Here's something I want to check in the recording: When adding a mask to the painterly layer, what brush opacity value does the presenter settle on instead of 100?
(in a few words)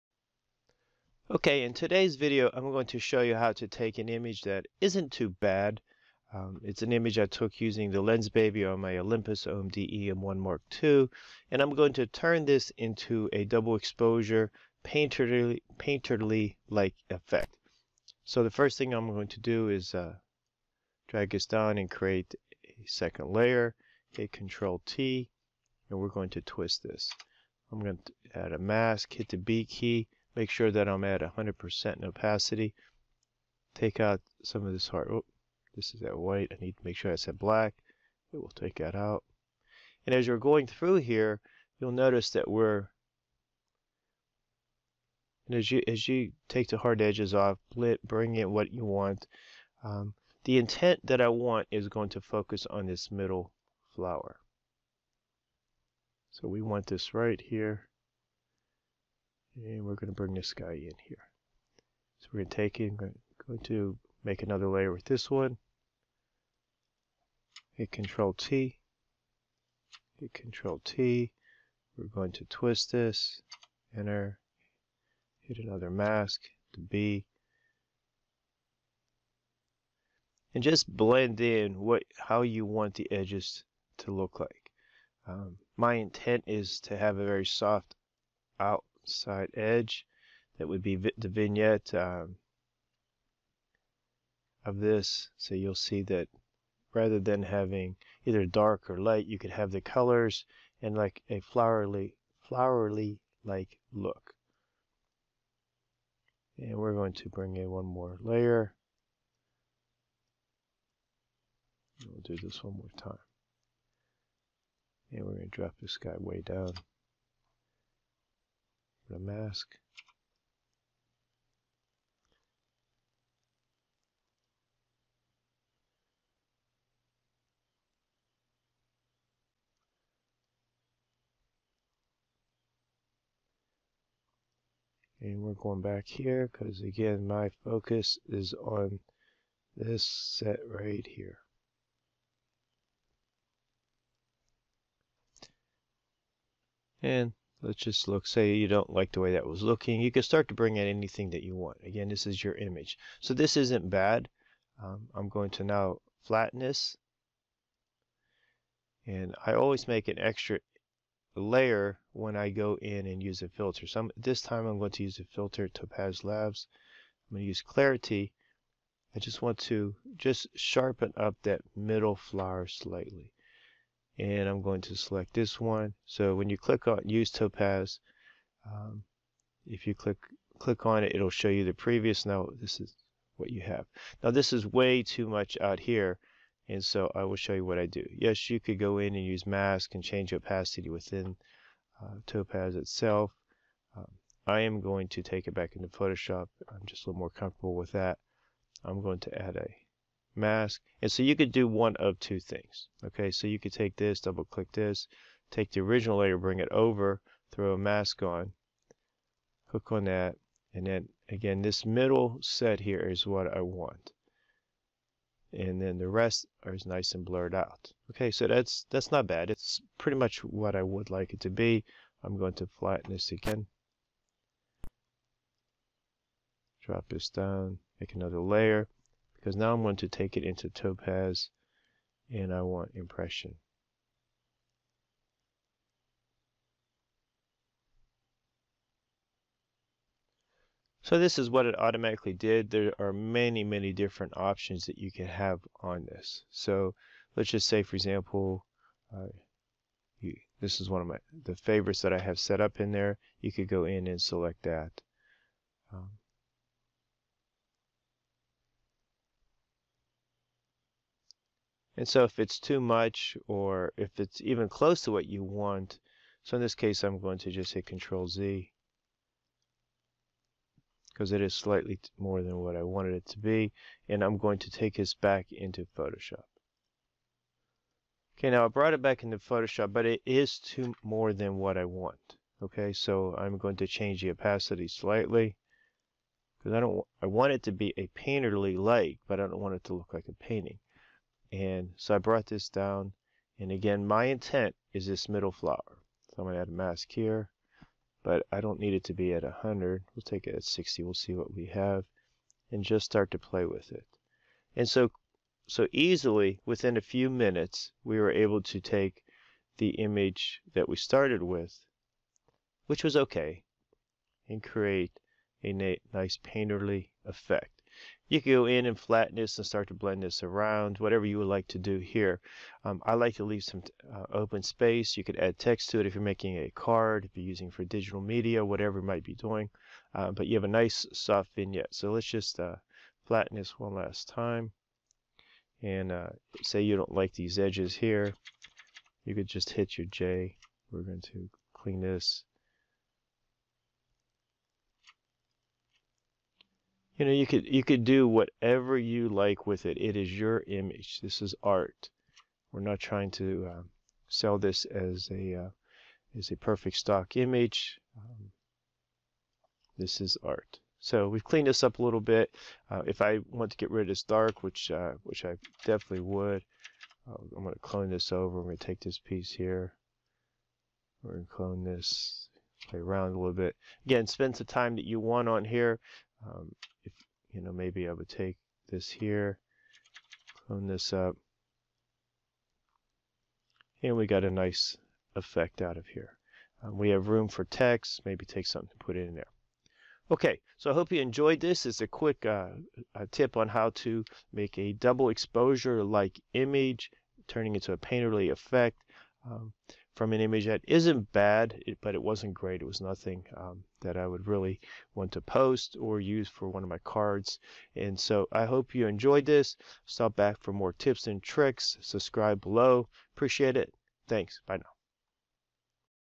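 60.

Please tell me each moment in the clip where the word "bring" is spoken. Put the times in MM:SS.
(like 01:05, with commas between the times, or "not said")
00:48, 01:00, 01:47, 02:30, 03:26.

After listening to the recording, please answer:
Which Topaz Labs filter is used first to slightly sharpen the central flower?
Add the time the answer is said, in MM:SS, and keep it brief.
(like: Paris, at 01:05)
Clarity, at 02:47.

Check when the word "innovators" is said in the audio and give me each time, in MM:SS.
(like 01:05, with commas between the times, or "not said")
not said.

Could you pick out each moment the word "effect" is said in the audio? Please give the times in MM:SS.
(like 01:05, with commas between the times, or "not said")
00:17, 05:17, 06:25, 06:38.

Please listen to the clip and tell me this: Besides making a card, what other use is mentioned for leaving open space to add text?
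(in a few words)
digital media.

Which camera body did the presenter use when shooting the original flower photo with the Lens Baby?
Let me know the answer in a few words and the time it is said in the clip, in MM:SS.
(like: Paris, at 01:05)
Olympus OMD EM1 Mark II, at 00:08.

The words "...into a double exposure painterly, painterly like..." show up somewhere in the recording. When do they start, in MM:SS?
00:12.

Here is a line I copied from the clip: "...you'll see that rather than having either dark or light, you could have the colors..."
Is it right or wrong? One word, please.
right.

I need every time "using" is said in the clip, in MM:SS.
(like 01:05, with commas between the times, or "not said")
00:07, 05:27.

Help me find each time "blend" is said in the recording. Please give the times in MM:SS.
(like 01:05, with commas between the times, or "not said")
01:20, 05:19.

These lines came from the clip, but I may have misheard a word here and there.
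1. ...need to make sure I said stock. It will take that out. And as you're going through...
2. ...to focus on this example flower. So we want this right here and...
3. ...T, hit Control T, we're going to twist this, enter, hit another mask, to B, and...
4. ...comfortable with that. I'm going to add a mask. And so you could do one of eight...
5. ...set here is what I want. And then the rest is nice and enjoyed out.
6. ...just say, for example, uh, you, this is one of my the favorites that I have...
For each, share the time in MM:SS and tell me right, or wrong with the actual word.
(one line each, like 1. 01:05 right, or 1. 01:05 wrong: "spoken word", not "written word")
1. 00:36 wrong: "black", not "stock"
2. 00:52 wrong: "middle", not "example"
3. 01:08 right
4. 03:17 wrong: "two", not "eight"
5. 03:32 wrong: "blurred", not "enjoyed"
6. 04:07 right.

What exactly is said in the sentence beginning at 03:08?
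Yes, you could go in and use mask and change opacity within uh, Topaz itself.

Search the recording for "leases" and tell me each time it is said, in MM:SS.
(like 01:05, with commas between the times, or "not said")
not said.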